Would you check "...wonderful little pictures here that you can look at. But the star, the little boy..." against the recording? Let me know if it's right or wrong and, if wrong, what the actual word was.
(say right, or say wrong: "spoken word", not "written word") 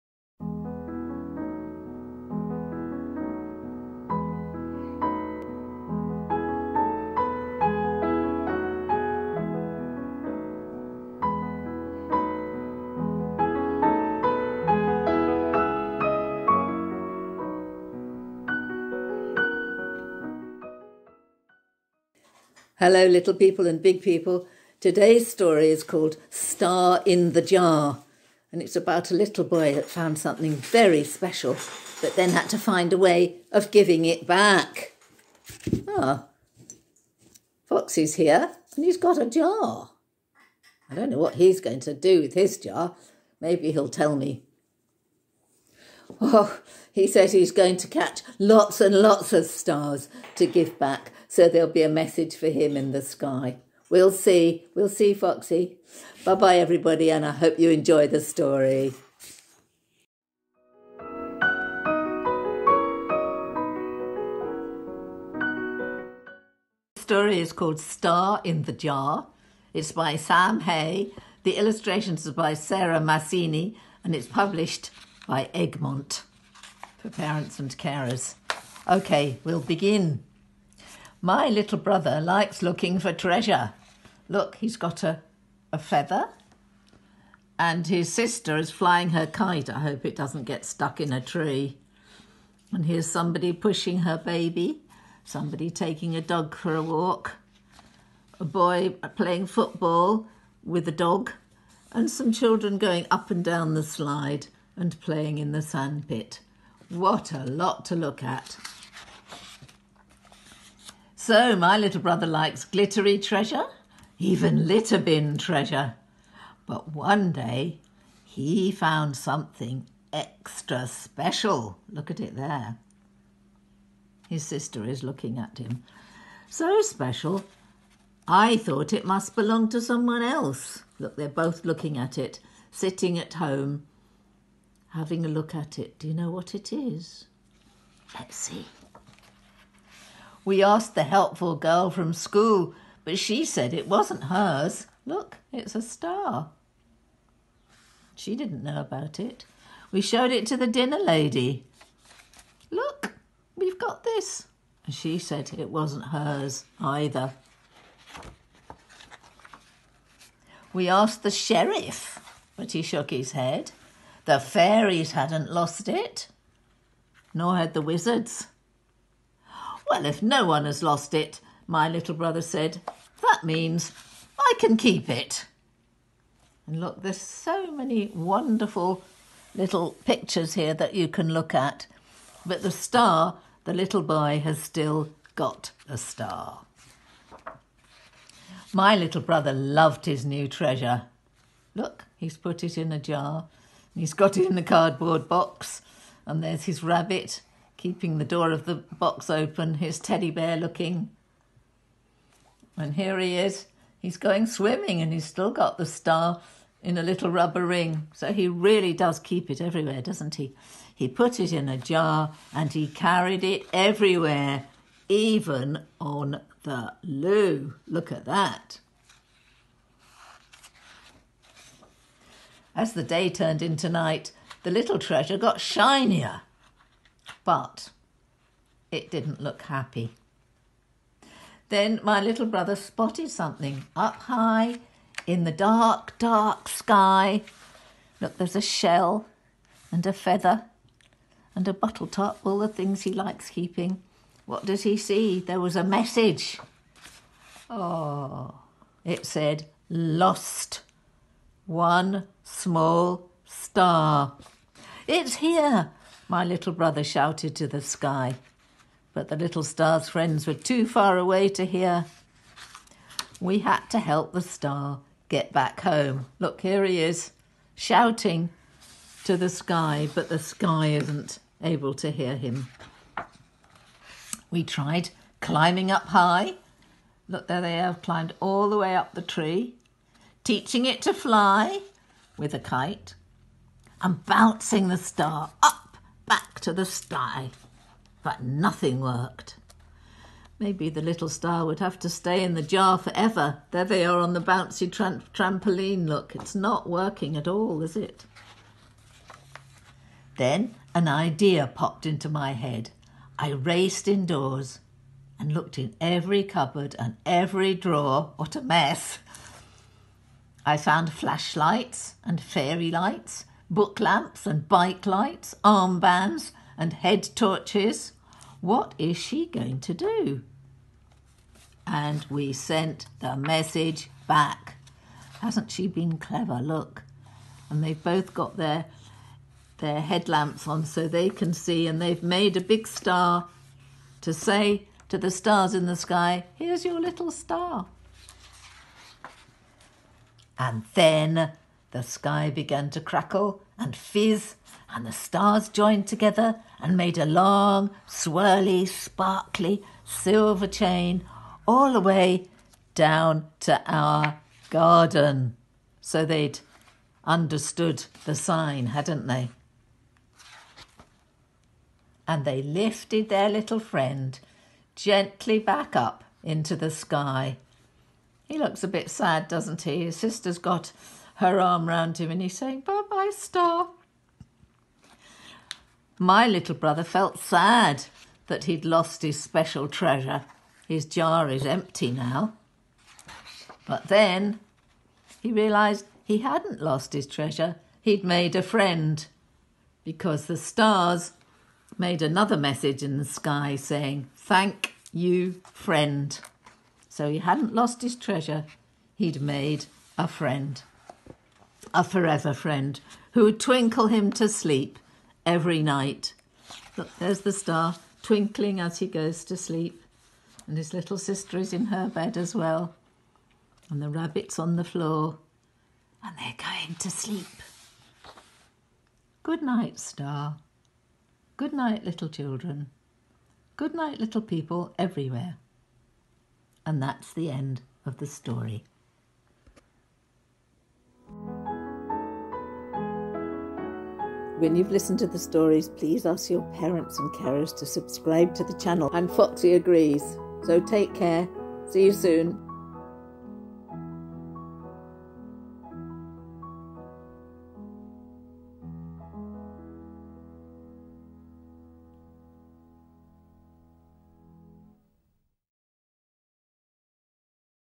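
right.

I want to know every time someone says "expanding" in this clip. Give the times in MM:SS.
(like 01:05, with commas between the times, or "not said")
not said.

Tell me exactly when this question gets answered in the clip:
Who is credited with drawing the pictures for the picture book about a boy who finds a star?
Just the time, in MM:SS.
01:12.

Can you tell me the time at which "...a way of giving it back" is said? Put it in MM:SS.
00:32.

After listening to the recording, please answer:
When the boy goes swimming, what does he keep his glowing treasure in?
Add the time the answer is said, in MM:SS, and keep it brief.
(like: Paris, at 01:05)
a little rubber ring, at 03:26.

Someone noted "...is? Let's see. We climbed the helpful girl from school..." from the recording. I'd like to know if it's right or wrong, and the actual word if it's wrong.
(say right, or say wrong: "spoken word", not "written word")
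wrong: "asked", not "climbed".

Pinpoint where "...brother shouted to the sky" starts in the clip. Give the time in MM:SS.
04:16.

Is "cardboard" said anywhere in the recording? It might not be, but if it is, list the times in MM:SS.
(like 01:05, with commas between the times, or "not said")
03:14.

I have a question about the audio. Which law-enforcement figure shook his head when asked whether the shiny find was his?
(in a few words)
the sheriff.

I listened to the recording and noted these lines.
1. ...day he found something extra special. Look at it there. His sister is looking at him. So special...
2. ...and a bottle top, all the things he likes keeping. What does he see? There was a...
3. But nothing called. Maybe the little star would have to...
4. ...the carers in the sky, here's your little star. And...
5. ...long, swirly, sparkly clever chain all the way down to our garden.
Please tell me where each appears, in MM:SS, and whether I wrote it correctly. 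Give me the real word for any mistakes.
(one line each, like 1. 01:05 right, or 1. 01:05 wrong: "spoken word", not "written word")
1. 01:57 right
2. 04:01 right
3. 04:48 wrong: "worked", not "called"
4. 05:35 wrong: "stars", not "carers"
5. 05:47 wrong: "silver", not "clever".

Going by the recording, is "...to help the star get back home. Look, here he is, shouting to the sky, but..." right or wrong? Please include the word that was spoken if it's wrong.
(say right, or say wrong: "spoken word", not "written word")
right.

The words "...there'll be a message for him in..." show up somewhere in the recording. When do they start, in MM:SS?
00:51.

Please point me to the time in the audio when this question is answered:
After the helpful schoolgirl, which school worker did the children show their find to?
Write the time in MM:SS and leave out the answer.
02:30.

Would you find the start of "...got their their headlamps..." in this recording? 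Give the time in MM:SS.
05:28.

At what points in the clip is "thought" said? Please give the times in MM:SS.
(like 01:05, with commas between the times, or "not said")
02:08.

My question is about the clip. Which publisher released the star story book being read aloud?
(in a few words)
Egmont.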